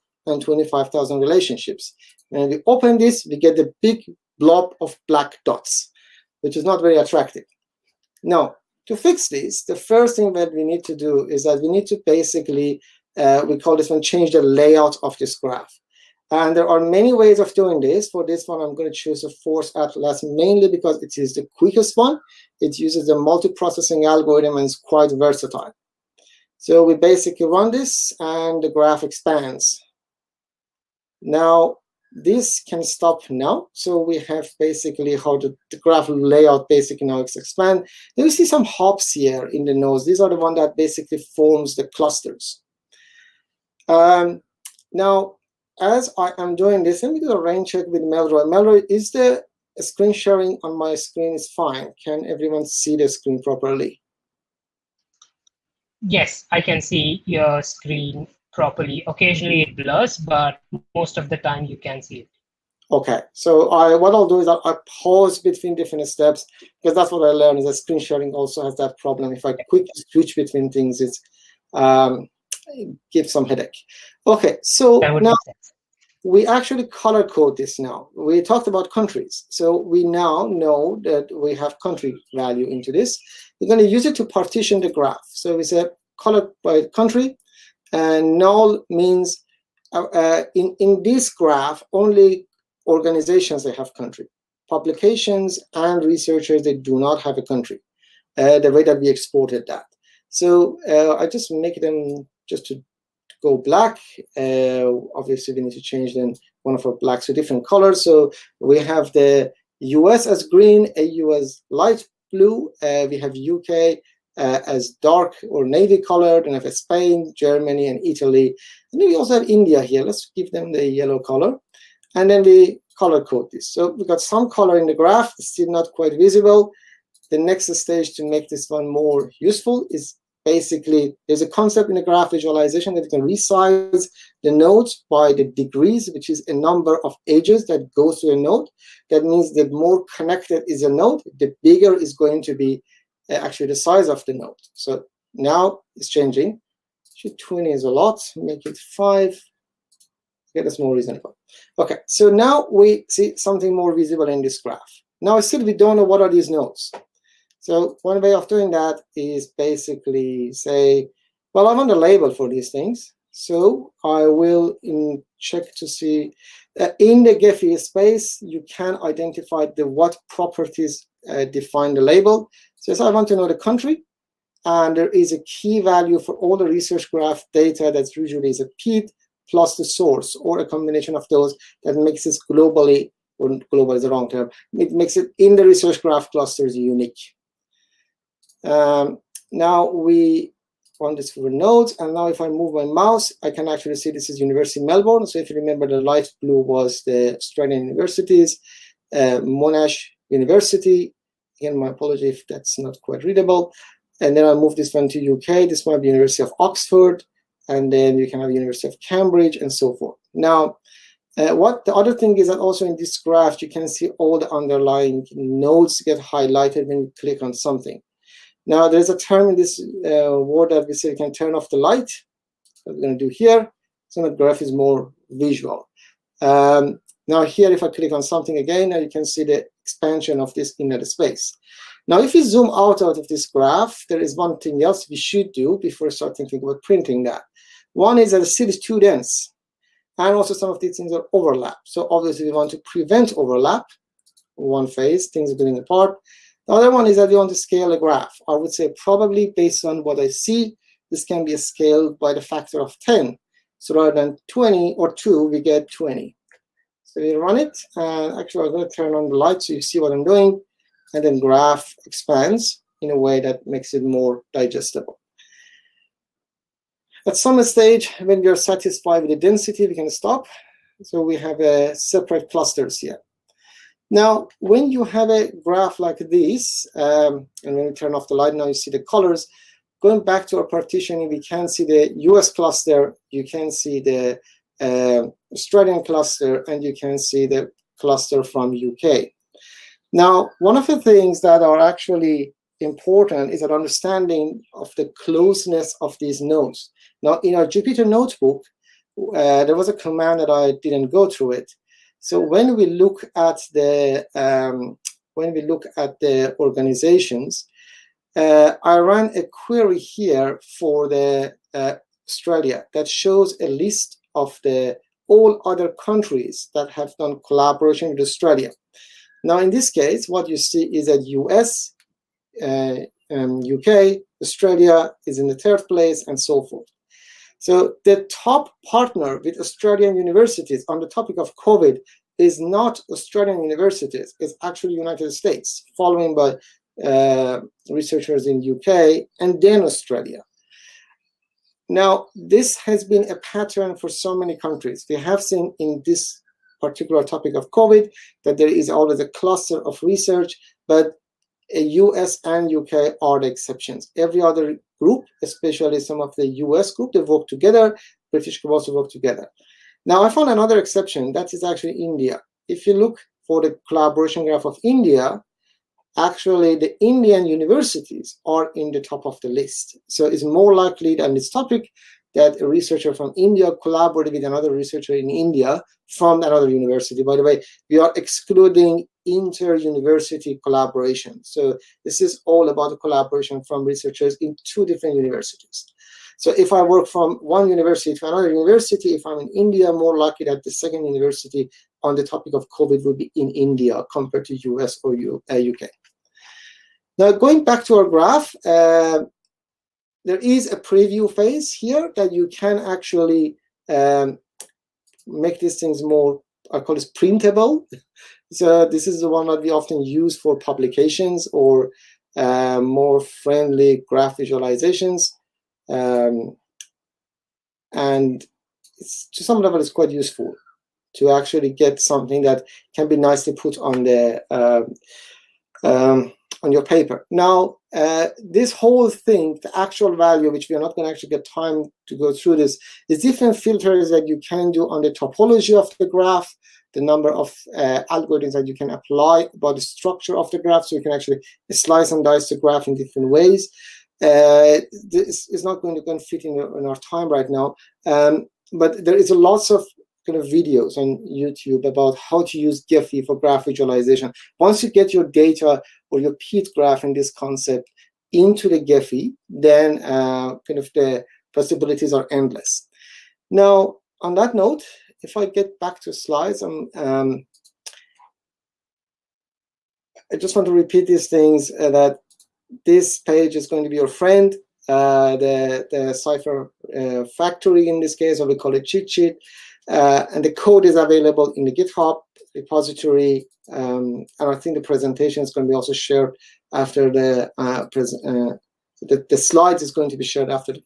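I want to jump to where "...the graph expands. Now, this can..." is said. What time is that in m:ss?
0:28.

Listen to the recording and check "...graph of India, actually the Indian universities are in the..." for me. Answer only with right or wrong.
right.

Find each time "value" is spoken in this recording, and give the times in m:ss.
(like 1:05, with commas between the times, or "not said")
1:22, 2:55, 7:10.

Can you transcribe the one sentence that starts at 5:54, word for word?
Every other group, especially some of the US group, they work together.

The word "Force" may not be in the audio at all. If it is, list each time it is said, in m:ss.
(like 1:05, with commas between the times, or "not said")
0:19.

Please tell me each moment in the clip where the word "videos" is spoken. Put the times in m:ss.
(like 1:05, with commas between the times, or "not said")
7:30.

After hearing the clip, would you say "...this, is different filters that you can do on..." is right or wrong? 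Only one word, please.
right.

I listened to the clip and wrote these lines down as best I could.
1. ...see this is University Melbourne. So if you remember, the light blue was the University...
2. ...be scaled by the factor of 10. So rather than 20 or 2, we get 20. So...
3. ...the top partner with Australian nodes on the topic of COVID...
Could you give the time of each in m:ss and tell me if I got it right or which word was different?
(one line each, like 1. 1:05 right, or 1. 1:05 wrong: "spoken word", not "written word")
1. 3:13 wrong: "Australian", not "University"
2. 4:11 right
3. 5:28 wrong: "universities", not "nodes".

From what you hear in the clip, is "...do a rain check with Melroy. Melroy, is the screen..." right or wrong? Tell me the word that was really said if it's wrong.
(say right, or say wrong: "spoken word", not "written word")
right.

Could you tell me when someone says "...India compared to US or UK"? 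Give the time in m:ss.
6:33.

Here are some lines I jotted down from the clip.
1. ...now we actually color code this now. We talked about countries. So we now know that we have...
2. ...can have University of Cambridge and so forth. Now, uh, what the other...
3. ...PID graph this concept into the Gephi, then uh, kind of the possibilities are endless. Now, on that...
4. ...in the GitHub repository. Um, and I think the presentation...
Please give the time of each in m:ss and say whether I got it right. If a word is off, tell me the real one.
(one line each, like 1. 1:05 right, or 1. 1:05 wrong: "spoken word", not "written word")
1. 1:15 right
2. 3:28 right
3. 7:36 right
4. 8:01 right.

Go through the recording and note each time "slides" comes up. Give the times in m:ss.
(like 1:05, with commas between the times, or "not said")
7:46, 8:09.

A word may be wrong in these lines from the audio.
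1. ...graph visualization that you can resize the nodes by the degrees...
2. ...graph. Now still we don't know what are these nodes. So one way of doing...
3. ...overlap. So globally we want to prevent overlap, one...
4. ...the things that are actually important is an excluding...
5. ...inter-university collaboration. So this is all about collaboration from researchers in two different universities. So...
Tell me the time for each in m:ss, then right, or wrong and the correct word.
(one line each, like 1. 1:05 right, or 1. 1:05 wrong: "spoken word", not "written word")
1. 2:12 right
2. 2:34 right
3. 4:01 wrong: "obviously", not "globally"
4. 4:50 wrong: "understanding", not "excluding"
5. 6:19 right.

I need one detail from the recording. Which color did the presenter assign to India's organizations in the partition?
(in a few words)
Yellow.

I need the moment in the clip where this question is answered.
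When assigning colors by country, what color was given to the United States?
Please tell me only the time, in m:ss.
1:50.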